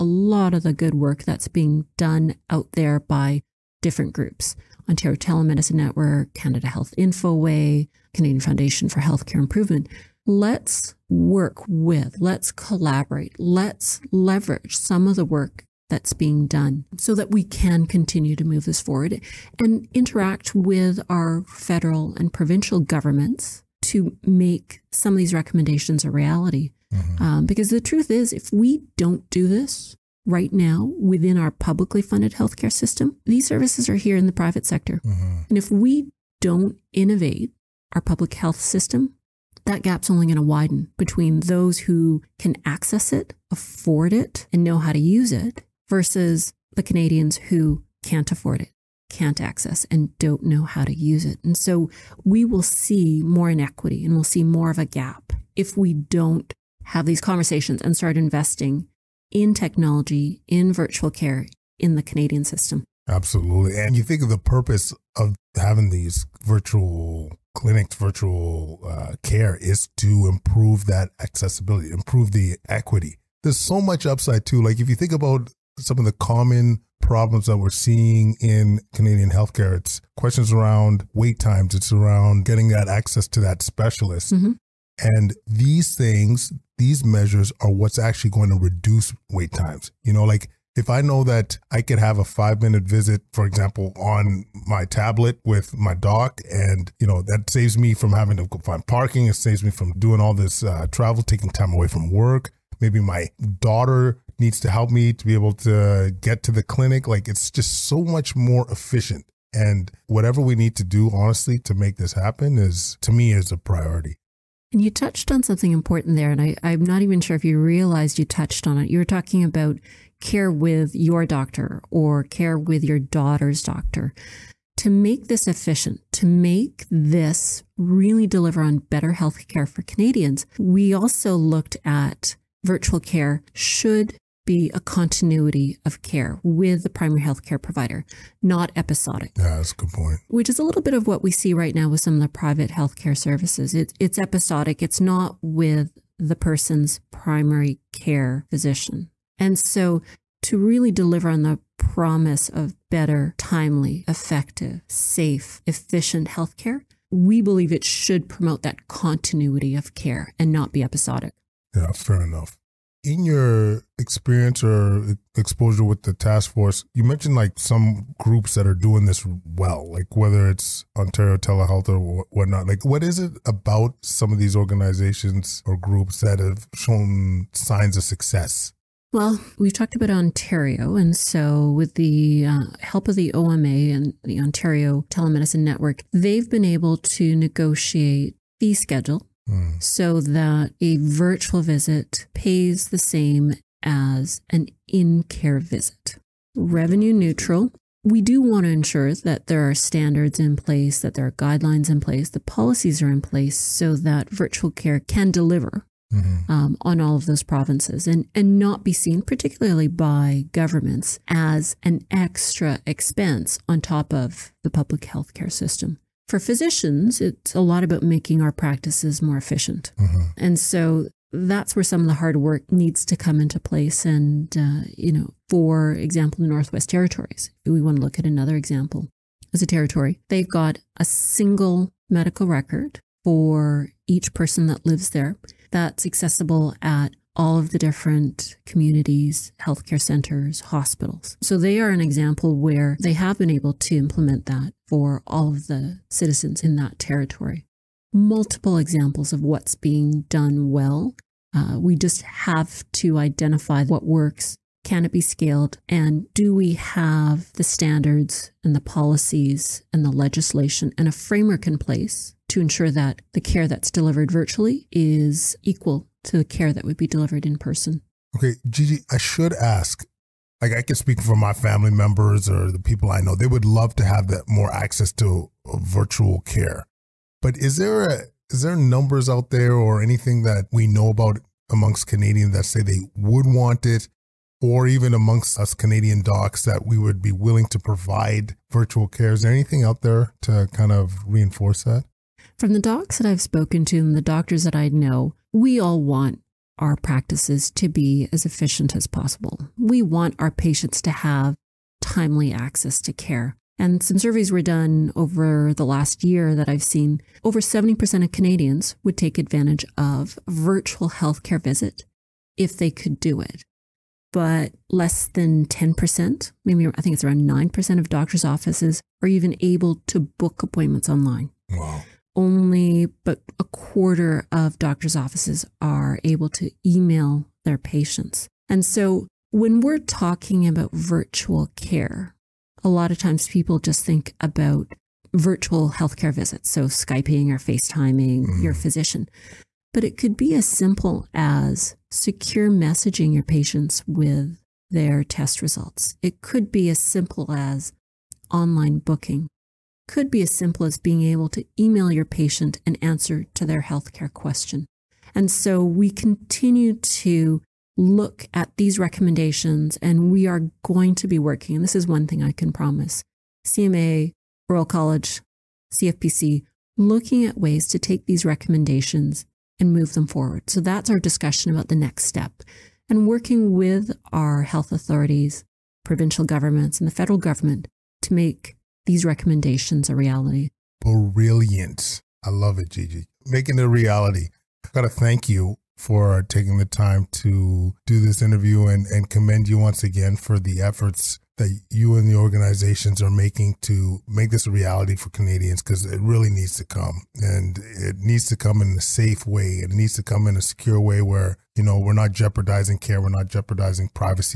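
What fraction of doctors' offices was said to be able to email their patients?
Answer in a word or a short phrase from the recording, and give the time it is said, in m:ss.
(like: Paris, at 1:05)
a quarter, at 5:23.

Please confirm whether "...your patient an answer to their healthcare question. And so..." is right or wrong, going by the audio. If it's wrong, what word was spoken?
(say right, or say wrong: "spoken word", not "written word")
right.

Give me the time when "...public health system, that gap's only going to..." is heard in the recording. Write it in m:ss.
0:38.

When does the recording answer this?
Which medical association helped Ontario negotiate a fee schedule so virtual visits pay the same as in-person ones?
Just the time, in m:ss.
3:03.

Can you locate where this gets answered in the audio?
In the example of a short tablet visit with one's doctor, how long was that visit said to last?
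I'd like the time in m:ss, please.
1:32.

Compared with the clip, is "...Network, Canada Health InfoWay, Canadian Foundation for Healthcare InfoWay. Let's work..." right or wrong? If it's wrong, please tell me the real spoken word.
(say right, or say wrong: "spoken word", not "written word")
wrong: "Improvement", not "InfoWay".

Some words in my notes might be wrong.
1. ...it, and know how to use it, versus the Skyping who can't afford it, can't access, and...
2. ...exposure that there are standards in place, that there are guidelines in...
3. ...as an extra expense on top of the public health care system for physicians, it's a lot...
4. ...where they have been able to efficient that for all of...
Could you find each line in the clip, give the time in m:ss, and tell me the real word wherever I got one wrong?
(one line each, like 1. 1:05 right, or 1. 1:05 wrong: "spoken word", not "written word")
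1. 0:44 wrong: "Canadians", not "Skyping"
2. 3:18 wrong: "ensure", not "exposure"
3. 3:31 right
4. 4:02 wrong: "implement", not "efficient".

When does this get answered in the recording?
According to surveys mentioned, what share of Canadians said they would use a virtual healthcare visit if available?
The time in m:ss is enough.
5:07.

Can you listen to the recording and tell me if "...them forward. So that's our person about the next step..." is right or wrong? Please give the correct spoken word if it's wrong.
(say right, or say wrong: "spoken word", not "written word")
wrong: "discussion", not "person".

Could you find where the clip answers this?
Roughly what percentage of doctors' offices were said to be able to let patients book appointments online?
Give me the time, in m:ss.
5:17.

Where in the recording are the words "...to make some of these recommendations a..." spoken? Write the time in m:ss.
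0:23.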